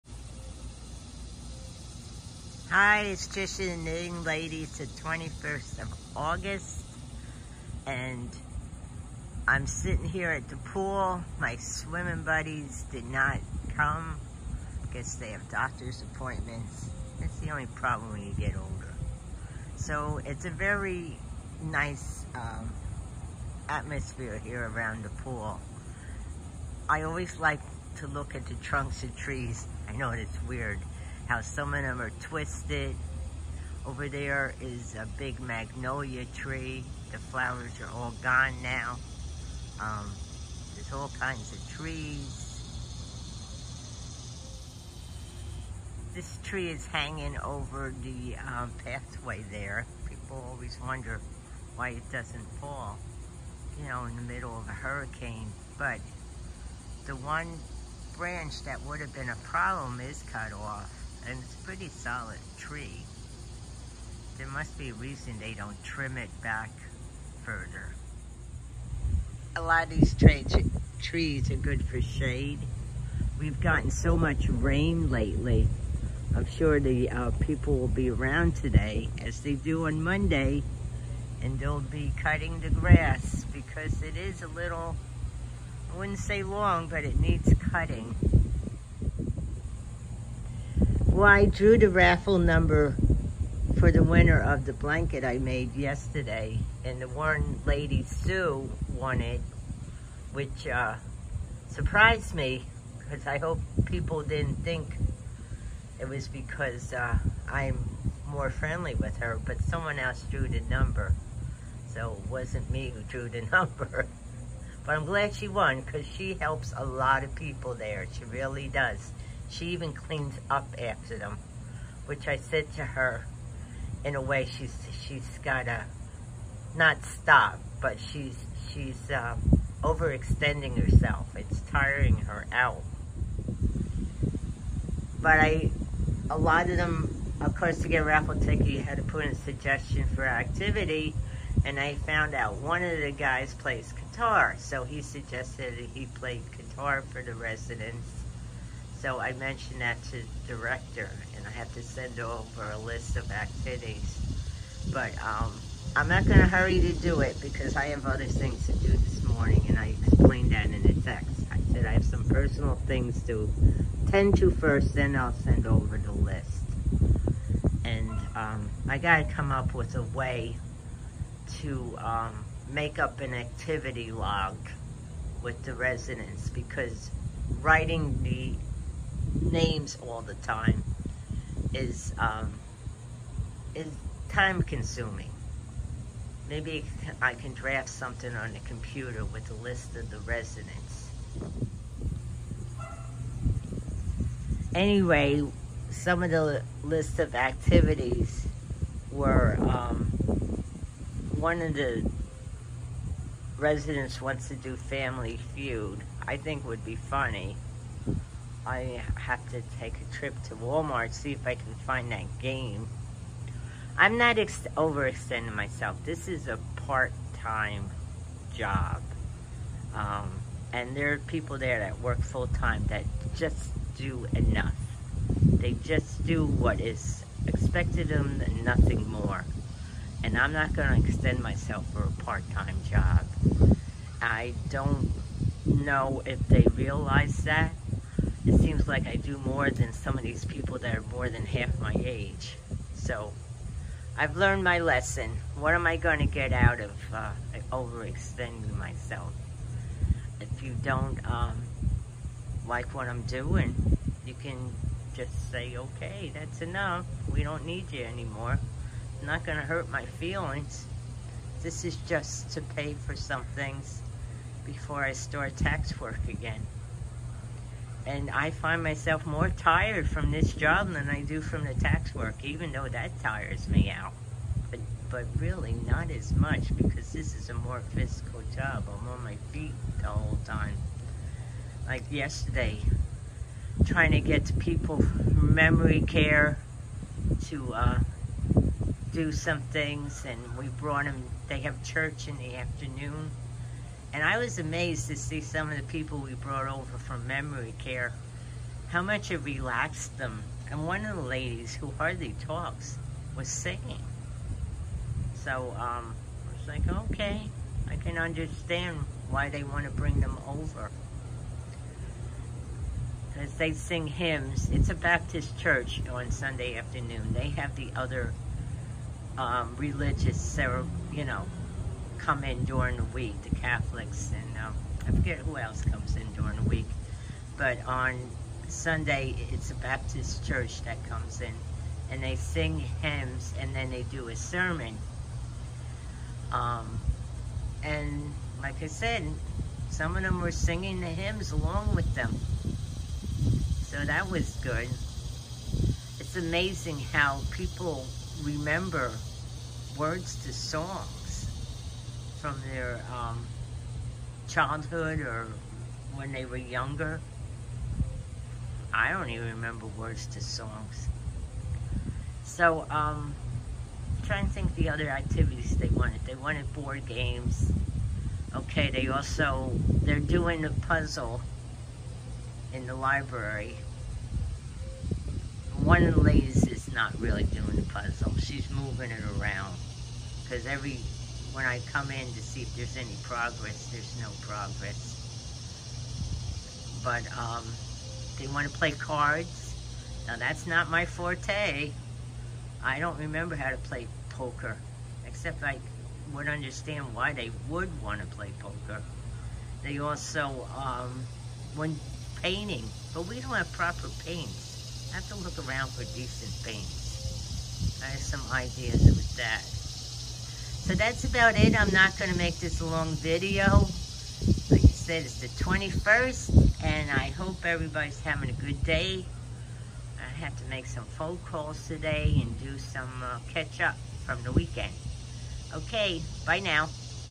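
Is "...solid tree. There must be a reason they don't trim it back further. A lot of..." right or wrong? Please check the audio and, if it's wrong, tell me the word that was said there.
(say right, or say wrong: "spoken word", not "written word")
right.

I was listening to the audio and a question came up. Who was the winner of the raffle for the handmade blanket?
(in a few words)
Sue.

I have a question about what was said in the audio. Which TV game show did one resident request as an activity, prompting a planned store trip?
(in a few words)
Family Feud.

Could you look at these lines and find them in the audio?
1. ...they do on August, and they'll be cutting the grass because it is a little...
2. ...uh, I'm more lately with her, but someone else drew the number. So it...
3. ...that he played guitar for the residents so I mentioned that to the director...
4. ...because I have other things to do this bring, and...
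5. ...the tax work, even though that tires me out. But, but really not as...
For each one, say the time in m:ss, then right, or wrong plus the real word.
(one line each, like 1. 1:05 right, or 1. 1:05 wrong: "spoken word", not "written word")
1. 1:19 wrong: "Monday", not "August"
2. 1:46 wrong: "friendly", not "lately"
3. 2:25 right
4. 2:37 wrong: "morning", not "bring"
5. 4:31 right.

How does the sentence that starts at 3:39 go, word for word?
Um, and there are people there that work full-time that just do enough.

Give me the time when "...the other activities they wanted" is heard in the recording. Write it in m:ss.
6:04.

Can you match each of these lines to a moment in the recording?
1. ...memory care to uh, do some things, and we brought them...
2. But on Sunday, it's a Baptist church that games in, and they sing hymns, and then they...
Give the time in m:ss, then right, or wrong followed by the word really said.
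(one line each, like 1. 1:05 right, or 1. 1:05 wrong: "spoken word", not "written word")
1. 4:45 right
2. 5:27 wrong: "comes", not "games".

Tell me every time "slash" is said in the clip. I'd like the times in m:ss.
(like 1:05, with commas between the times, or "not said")
not said.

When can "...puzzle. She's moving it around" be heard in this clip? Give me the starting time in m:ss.
6:17.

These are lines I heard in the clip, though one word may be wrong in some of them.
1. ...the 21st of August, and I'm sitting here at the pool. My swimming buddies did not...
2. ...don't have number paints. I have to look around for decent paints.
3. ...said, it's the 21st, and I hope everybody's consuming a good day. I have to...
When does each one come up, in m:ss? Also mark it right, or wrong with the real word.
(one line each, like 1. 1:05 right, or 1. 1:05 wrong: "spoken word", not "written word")
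1. 0:04 right
2. 6:43 wrong: "proper", not "number"
3. 6:54 wrong: "having", not "consuming".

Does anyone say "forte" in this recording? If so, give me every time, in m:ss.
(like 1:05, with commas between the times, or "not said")
6:31.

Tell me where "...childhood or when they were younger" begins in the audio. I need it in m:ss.
5:54.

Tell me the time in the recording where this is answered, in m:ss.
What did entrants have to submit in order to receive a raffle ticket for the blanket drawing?
2:19.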